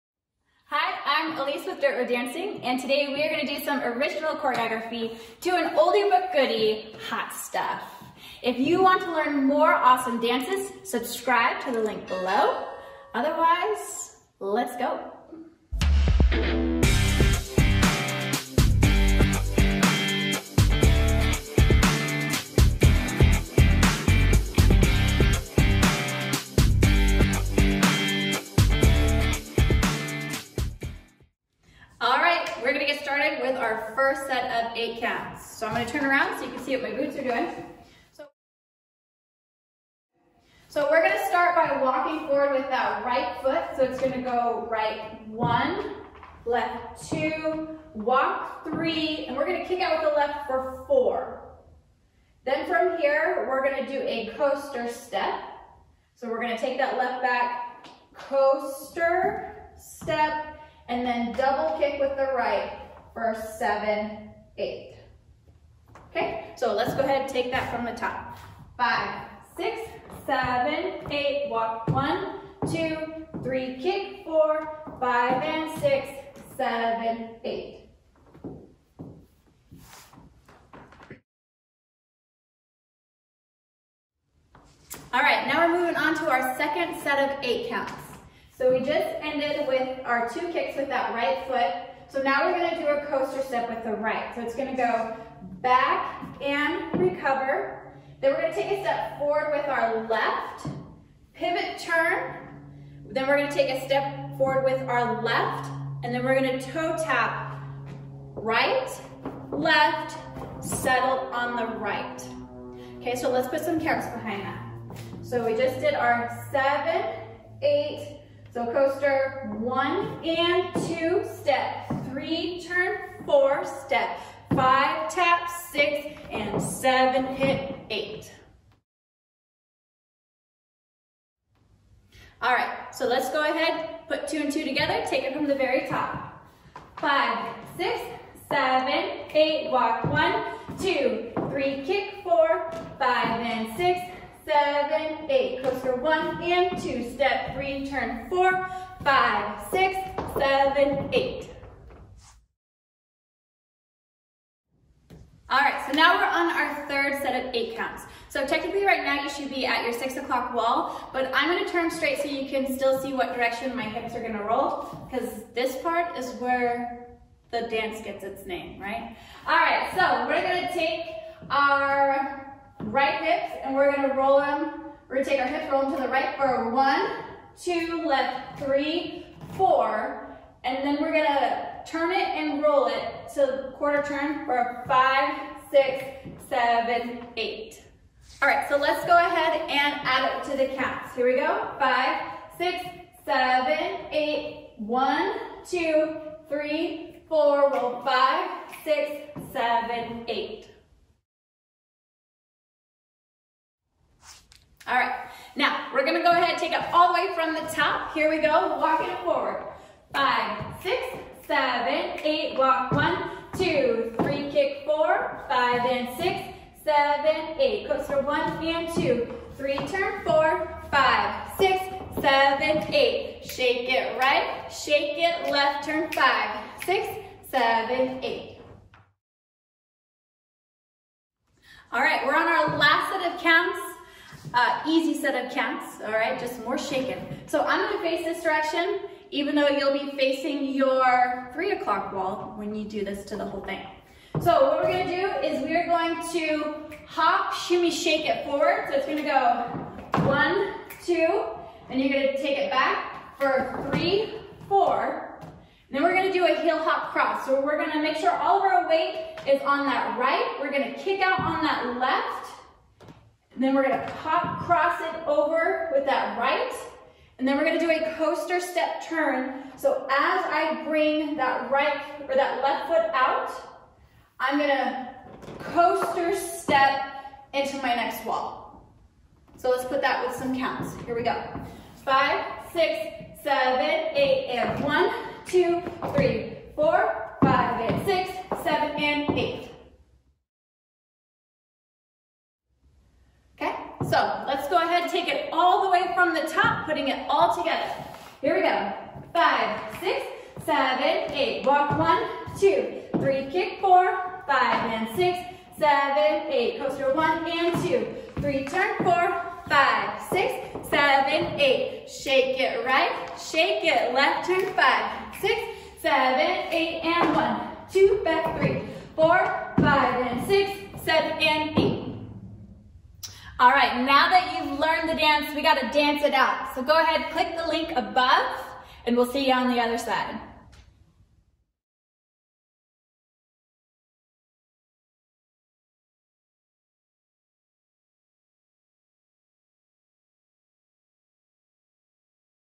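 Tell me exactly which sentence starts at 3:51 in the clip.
All right, we're on our last set of counts.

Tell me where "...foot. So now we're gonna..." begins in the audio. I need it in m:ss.
1:31.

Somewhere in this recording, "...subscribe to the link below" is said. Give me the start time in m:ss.
0:10.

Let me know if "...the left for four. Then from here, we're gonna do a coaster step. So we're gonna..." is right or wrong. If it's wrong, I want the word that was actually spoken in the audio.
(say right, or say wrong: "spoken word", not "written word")
right.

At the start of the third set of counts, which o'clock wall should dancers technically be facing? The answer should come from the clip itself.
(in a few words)
6 o'clock.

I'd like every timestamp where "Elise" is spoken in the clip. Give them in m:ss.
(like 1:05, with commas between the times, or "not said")
0:01.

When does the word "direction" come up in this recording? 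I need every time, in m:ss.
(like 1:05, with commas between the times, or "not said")
2:43, 3:58.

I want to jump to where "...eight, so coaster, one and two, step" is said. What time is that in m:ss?
1:57.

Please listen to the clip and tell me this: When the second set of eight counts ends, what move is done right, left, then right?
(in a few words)
toe tap.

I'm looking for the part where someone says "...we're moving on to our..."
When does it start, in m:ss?
1:25.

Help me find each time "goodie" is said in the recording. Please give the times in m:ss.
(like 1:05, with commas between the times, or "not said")
0:06.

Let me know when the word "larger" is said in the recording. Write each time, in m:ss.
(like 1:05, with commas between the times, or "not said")
not said.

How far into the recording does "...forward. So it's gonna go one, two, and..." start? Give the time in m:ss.
4:08.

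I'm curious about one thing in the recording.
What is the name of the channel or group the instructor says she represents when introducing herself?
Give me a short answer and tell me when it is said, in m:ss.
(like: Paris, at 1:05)
Dirt Road Dancing, at 0:01.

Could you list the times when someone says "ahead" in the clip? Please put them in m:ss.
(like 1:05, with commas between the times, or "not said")
1:06, 2:13, 3:09, 3:26, 4:54, 5:26.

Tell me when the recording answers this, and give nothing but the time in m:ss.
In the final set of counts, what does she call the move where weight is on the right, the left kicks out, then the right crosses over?
4:16.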